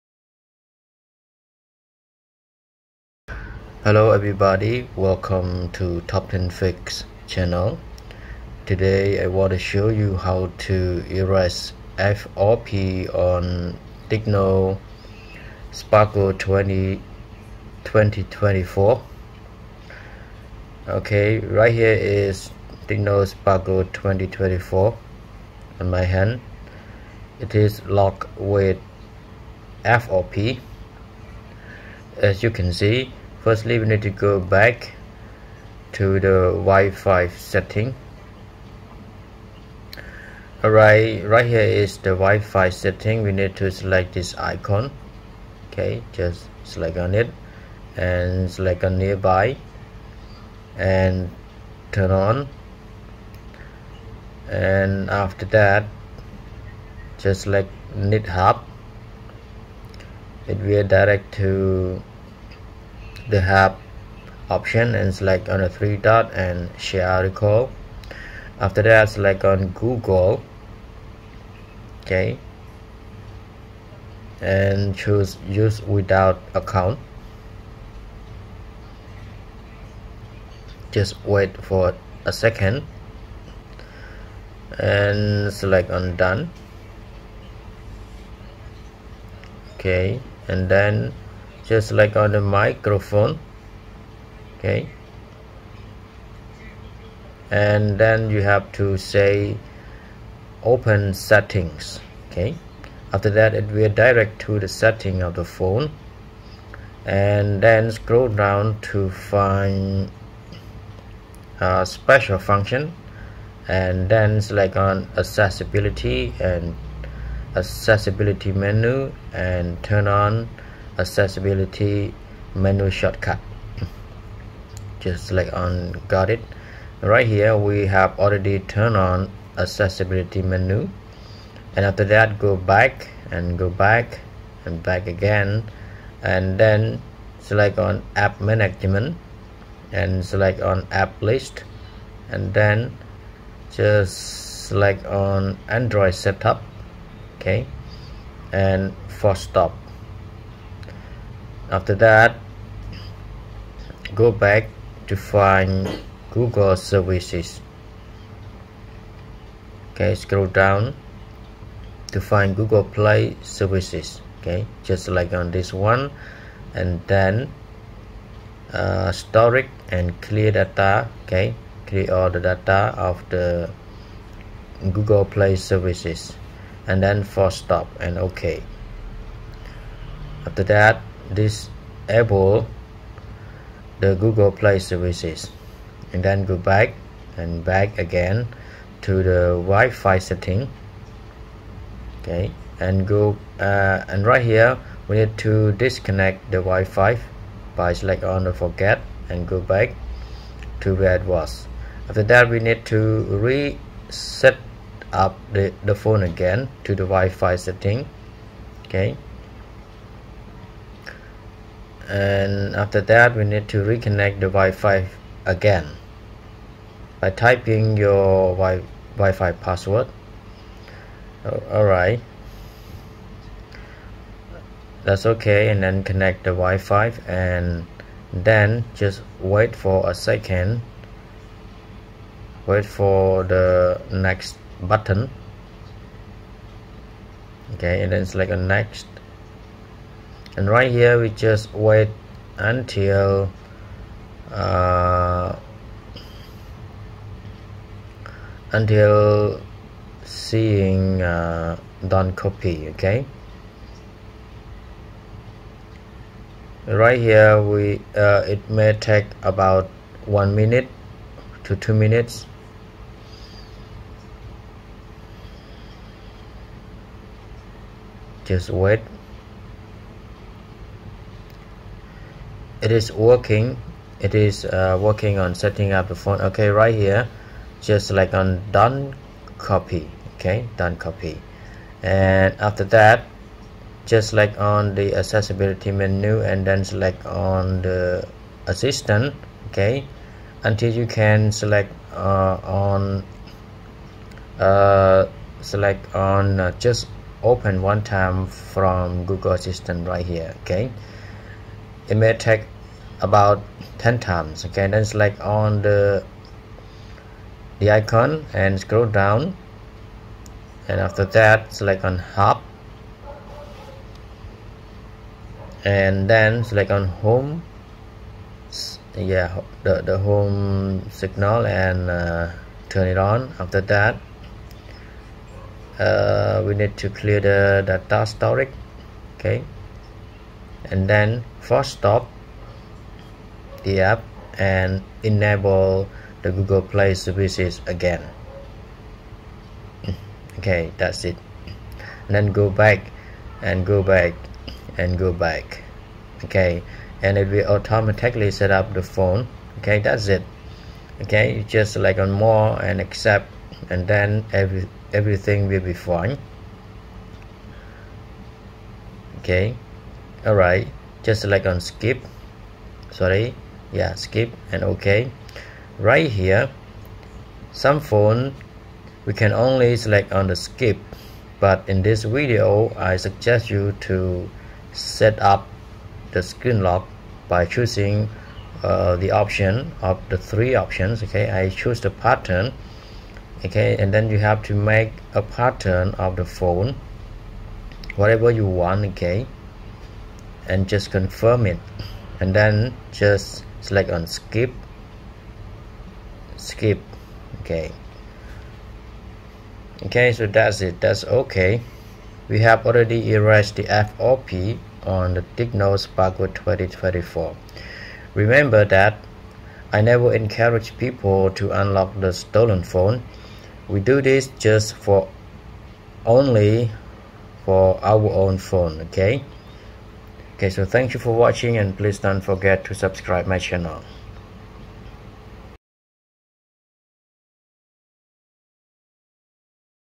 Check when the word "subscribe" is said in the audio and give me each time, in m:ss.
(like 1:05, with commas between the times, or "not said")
7:02.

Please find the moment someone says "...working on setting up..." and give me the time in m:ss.
4:35.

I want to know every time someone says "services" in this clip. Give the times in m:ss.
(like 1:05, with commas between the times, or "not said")
2:36, 2:43, 2:55, 3:04, 5:37.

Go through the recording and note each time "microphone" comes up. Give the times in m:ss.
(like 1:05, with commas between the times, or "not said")
1:32.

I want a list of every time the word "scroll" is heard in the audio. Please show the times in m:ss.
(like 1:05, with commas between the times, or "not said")
1:47, 2:40, 5:08.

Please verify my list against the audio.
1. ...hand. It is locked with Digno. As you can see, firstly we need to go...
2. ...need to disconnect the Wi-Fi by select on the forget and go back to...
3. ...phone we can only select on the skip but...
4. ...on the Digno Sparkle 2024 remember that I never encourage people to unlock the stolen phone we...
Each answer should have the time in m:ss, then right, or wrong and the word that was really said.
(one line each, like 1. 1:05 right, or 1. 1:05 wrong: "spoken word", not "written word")
1. 0:26 wrong: "FOP", not "Digno"
2. 3:15 right
3. 6:07 right
4. 6:45 right.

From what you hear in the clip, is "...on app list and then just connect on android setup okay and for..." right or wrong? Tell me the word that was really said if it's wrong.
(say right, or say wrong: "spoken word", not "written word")
wrong: "select", not "connect".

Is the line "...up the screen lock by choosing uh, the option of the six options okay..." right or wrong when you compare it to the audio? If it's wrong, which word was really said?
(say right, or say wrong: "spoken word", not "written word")
wrong: "three", not "six".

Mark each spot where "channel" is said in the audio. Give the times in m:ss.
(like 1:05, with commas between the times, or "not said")
0:07, 7:03.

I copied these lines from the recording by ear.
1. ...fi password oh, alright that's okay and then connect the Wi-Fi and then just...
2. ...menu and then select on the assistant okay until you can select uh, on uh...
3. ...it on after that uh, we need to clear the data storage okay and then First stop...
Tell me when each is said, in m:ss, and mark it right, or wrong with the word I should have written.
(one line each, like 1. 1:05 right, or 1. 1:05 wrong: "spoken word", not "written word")
1. 3:39 right
2. 4:45 right
3. 5:23 right.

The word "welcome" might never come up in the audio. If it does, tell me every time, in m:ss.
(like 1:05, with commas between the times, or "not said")
0:04.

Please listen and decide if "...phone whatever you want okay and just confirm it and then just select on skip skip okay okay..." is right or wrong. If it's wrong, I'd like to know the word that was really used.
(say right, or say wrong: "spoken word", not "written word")
right.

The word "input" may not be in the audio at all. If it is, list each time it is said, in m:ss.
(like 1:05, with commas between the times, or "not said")
not said.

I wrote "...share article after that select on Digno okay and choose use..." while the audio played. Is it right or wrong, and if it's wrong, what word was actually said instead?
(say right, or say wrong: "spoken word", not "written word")
wrong: "Google", not "Digno".